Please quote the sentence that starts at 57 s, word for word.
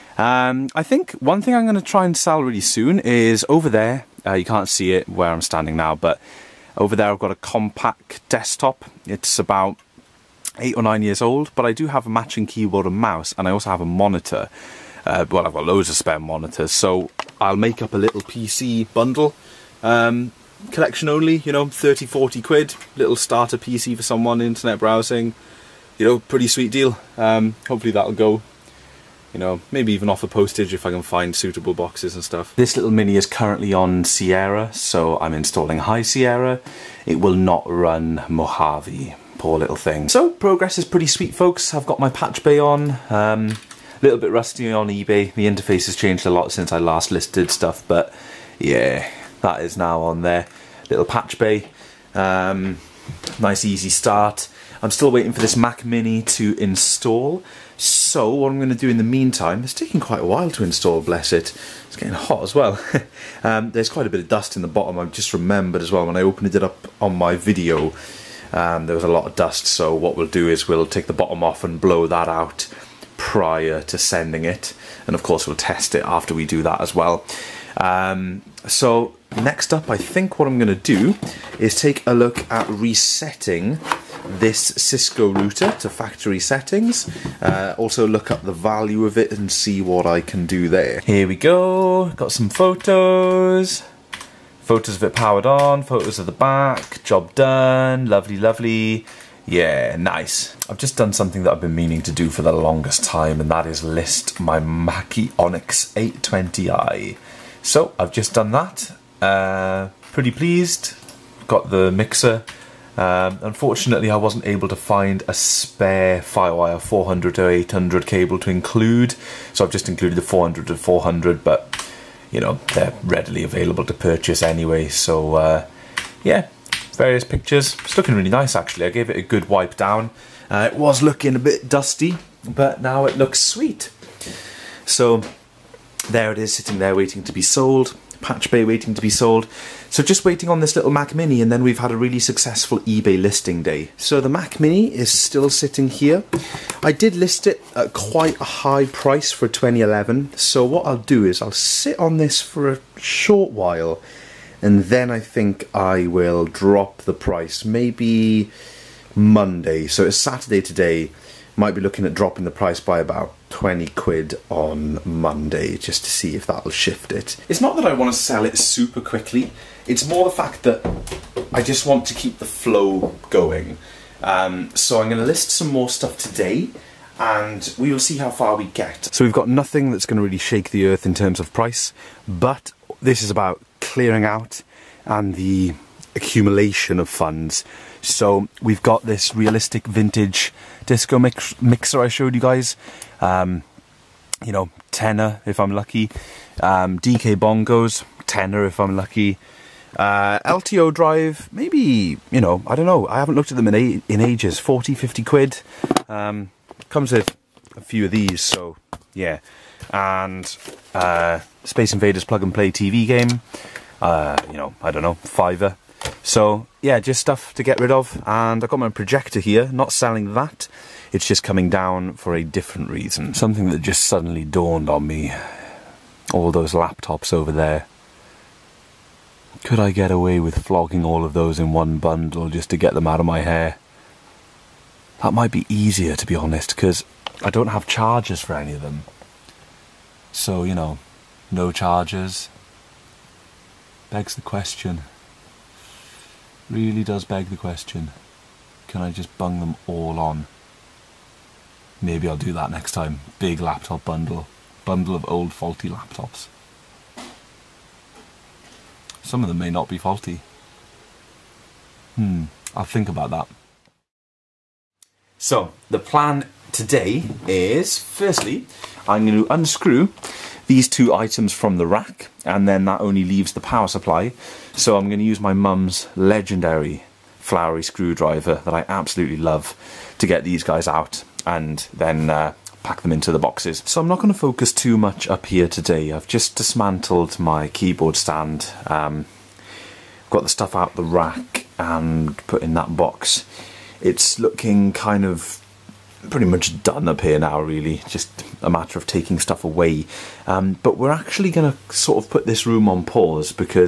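So what I'm going to do in the meantime, it's taking quite a while to install, bless it.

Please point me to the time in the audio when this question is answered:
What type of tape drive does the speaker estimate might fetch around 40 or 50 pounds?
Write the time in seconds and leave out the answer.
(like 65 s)
200 s.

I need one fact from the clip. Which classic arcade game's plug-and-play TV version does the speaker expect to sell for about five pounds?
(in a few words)
Space Invaders.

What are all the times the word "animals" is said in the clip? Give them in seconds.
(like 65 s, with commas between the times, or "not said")
not said.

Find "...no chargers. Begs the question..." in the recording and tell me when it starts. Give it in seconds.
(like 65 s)
241 s.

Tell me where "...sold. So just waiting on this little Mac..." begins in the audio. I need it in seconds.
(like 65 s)
139 s.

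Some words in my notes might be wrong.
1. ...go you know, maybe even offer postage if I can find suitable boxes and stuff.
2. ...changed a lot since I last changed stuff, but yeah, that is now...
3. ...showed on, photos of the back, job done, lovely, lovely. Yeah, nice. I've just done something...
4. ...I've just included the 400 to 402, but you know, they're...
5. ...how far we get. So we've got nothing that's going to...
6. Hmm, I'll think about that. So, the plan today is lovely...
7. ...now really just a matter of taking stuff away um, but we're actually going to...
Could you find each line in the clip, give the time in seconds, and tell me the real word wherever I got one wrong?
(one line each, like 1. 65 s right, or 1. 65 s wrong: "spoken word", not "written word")
1. 28 s right
2. 45 s wrong: "listed", not "changed"
3. 95 s wrong: "powered", not "showed"
4. 119 s wrong: "400", not "402"
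5. 178 s right
6. 262 s wrong: "firstly", not "lovely"
7. 297 s right.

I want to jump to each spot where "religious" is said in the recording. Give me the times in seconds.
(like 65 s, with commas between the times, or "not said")
not said.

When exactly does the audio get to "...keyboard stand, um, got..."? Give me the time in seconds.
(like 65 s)
287 s.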